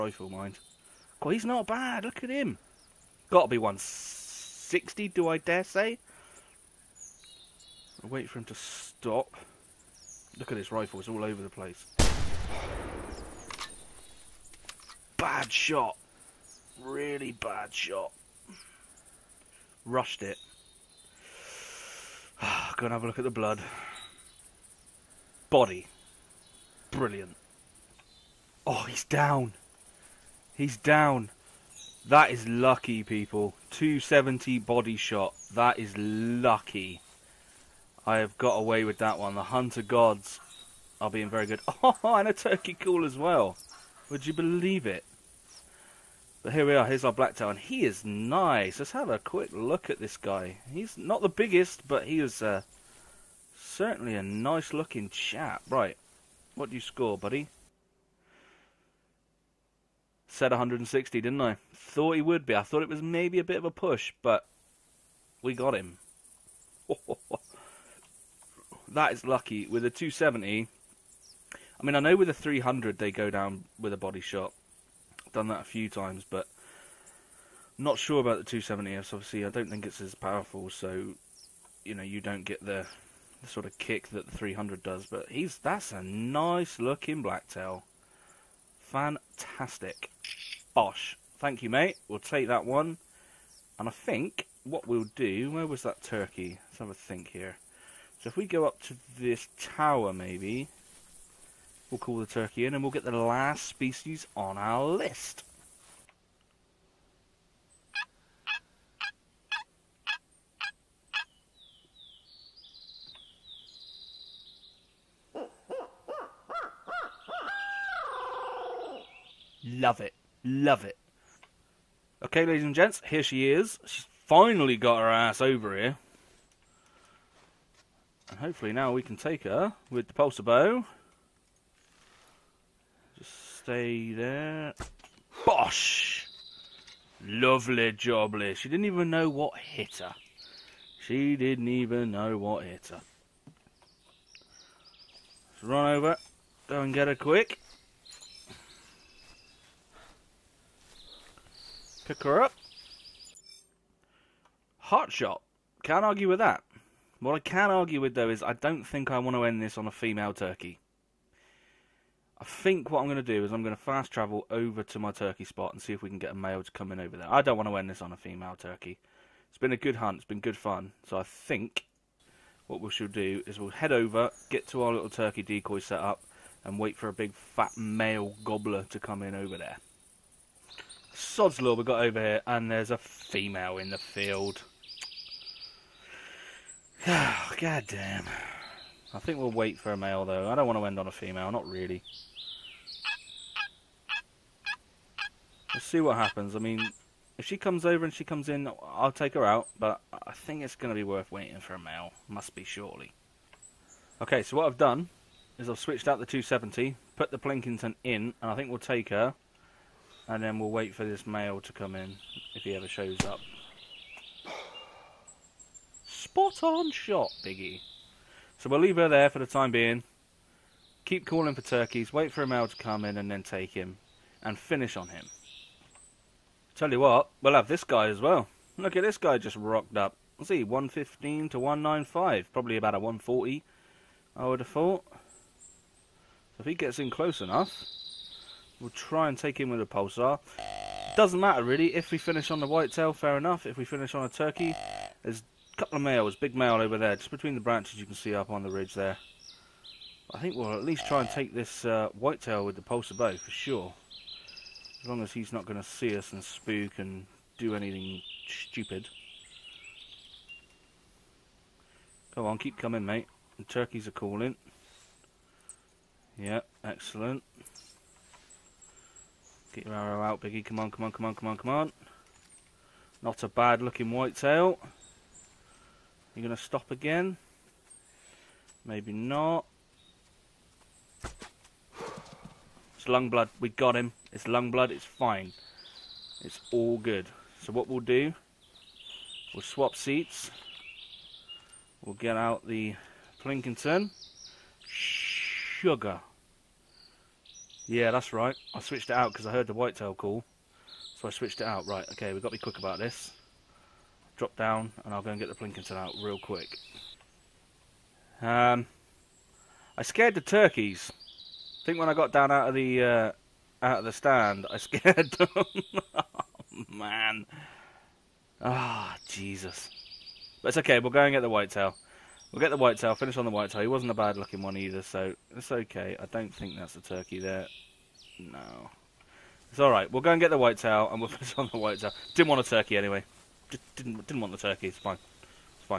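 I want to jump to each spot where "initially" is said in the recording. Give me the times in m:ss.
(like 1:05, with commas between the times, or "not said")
not said.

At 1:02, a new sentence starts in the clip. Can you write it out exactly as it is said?
I thought it was maybe a bit of a push, but we got him.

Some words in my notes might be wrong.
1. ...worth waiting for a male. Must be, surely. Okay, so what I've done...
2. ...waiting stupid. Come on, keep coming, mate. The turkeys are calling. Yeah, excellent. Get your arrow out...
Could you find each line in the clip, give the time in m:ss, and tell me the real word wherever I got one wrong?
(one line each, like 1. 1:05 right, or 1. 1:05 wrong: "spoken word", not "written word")
1. 3:21 right
2. 4:17 wrong: "anything", not "waiting".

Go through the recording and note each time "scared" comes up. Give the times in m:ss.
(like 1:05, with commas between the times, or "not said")
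5:10, 5:14.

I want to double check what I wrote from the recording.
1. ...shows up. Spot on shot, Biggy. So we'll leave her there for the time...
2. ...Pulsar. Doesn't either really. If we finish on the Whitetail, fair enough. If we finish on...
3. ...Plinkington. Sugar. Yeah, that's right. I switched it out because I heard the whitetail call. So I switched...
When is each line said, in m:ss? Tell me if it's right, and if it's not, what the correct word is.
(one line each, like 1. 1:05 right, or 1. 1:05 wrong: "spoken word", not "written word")
1. 3:32 right
2. 3:59 wrong: "matter", not "either"
3. 4:53 right.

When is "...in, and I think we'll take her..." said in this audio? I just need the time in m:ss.
3:28.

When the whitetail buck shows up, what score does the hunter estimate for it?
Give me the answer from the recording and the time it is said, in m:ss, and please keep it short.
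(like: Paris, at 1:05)
140, at 3:52.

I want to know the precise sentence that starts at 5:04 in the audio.
Drop down, and I'll go and get the Plinkington out real quick.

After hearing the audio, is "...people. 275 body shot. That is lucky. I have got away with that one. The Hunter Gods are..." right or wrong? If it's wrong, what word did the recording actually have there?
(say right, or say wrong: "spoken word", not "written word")
wrong: "270", not "275".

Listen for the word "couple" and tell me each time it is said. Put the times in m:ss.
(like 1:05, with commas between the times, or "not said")
4:05.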